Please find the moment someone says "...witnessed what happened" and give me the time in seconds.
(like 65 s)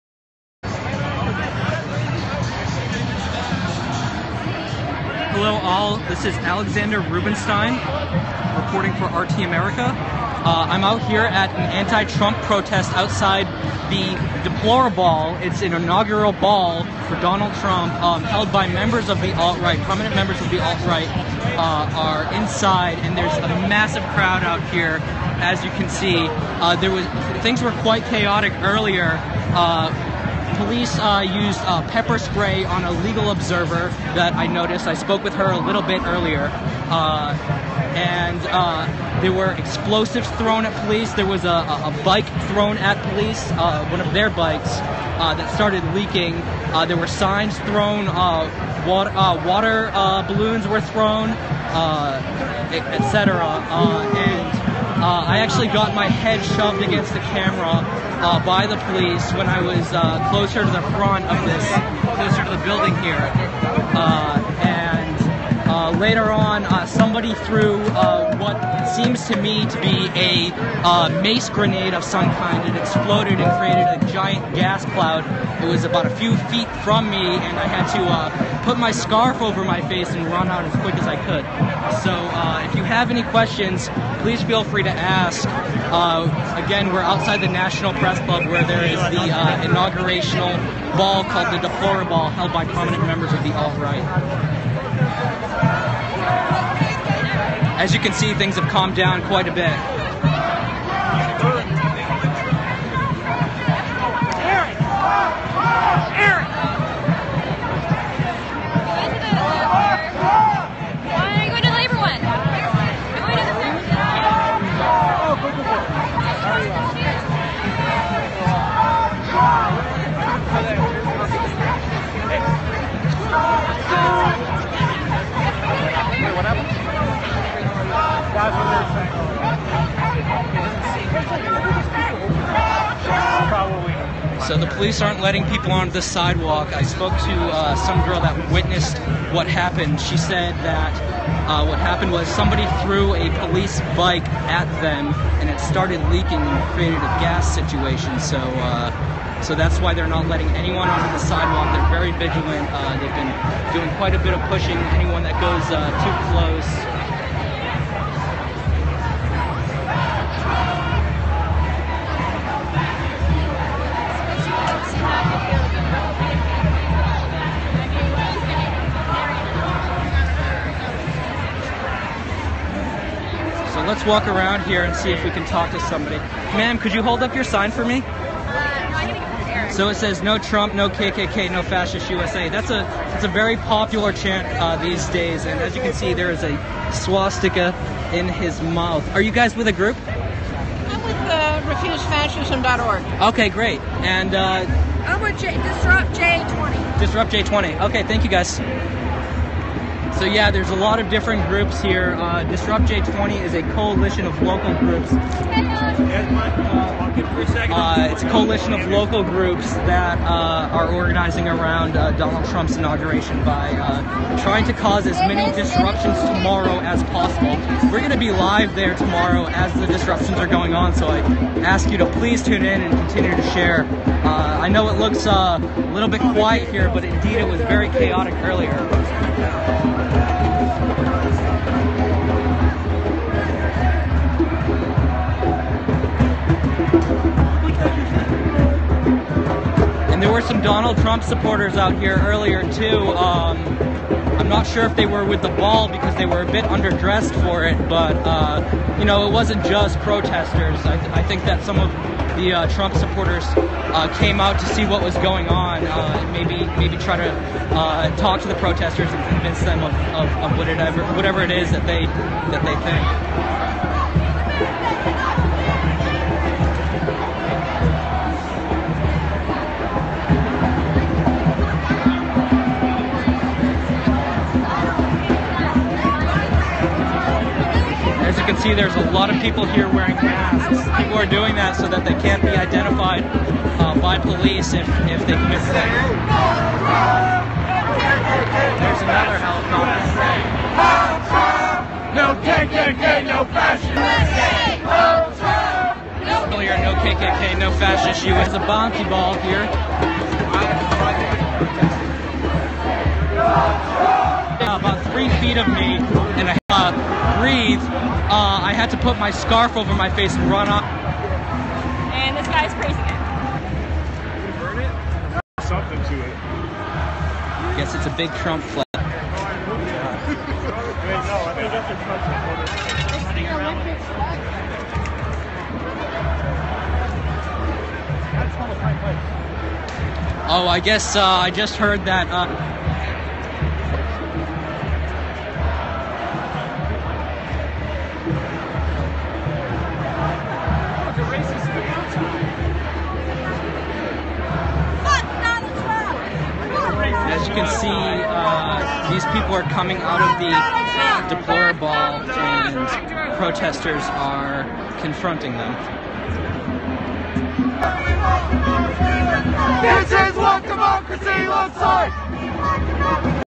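138 s.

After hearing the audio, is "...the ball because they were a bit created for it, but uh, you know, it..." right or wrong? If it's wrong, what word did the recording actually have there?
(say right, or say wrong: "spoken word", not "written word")
wrong: "underdressed", not "created".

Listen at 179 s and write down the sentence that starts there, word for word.
So it says no Trump, no KKK, no fascist USA.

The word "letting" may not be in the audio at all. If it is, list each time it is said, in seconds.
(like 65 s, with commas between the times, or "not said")
135 s, 150 s.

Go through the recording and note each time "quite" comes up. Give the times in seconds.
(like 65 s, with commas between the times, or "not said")
27 s, 99 s, 153 s.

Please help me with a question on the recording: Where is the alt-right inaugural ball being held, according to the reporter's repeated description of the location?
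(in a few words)
National Press Club.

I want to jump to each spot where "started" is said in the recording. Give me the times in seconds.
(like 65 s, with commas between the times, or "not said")
45 s, 145 s.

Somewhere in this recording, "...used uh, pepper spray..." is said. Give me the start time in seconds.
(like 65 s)
31 s.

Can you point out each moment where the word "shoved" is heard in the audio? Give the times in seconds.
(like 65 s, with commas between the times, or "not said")
56 s.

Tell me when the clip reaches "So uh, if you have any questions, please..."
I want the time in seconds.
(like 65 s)
82 s.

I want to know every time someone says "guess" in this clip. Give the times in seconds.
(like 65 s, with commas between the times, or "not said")
317 s, 330 s.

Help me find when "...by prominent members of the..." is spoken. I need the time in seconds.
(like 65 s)
92 s.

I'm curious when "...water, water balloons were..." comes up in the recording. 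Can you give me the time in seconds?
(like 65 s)
48 s.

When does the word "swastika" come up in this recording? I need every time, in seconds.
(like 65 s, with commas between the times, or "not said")
186 s.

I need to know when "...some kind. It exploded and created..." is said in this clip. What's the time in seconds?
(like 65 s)
72 s.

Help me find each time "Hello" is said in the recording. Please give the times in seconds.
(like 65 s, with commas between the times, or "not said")
5 s.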